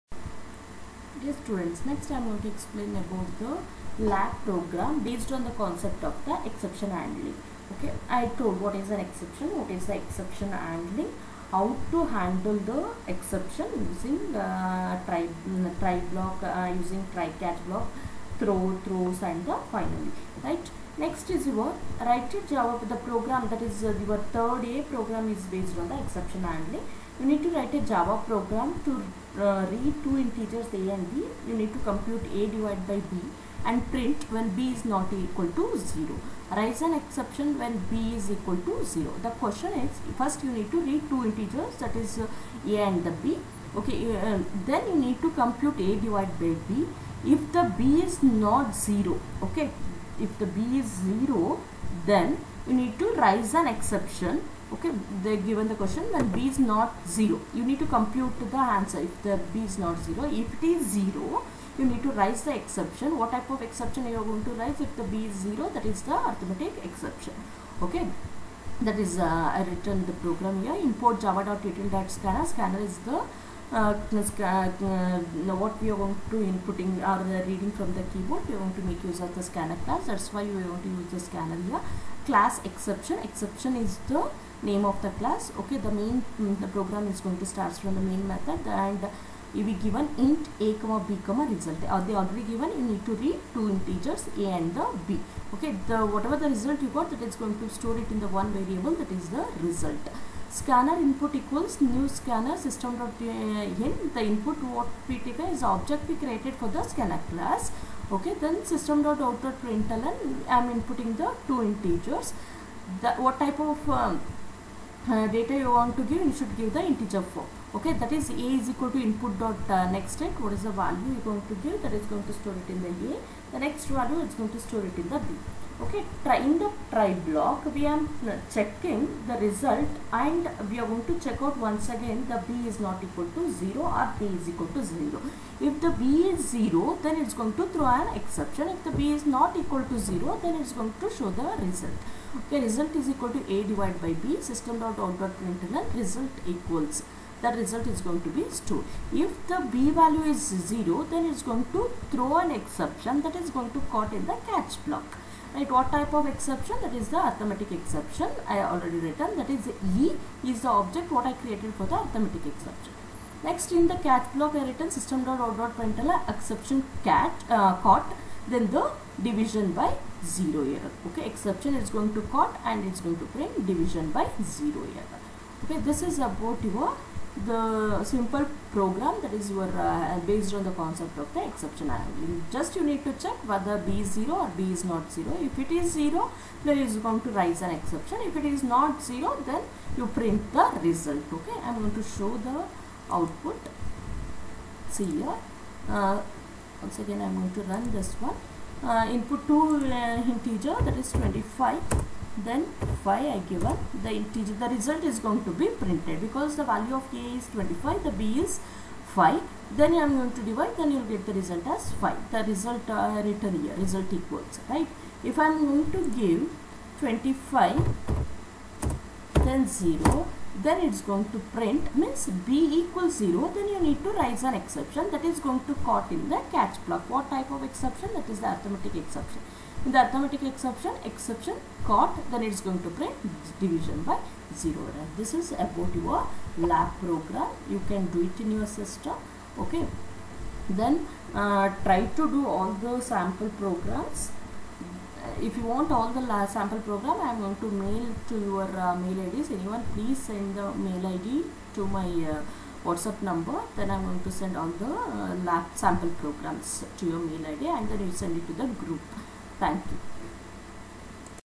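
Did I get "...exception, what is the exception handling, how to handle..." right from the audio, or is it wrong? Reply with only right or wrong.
right.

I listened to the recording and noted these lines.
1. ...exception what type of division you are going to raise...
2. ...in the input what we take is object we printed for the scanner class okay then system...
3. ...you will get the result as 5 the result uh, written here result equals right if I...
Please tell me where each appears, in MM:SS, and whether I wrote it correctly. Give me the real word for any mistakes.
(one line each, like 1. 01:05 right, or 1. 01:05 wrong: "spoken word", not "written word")
1. 01:02 wrong: "exception", not "division"
2. 01:43 wrong: "created", not "printed"
3. 03:30 right.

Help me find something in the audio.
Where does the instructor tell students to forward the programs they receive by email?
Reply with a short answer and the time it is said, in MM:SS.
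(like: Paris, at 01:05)
the group, at 04:18.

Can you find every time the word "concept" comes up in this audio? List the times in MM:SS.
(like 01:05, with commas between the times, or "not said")
00:05, 03:00.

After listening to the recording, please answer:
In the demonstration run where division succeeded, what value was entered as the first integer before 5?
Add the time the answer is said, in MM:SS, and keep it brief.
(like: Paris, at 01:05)
25, at 03:21.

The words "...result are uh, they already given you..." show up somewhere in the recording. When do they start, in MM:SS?
01:31.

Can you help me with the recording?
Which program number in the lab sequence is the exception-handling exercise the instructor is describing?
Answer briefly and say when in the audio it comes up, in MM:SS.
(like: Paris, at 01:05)
3A, at 00:24.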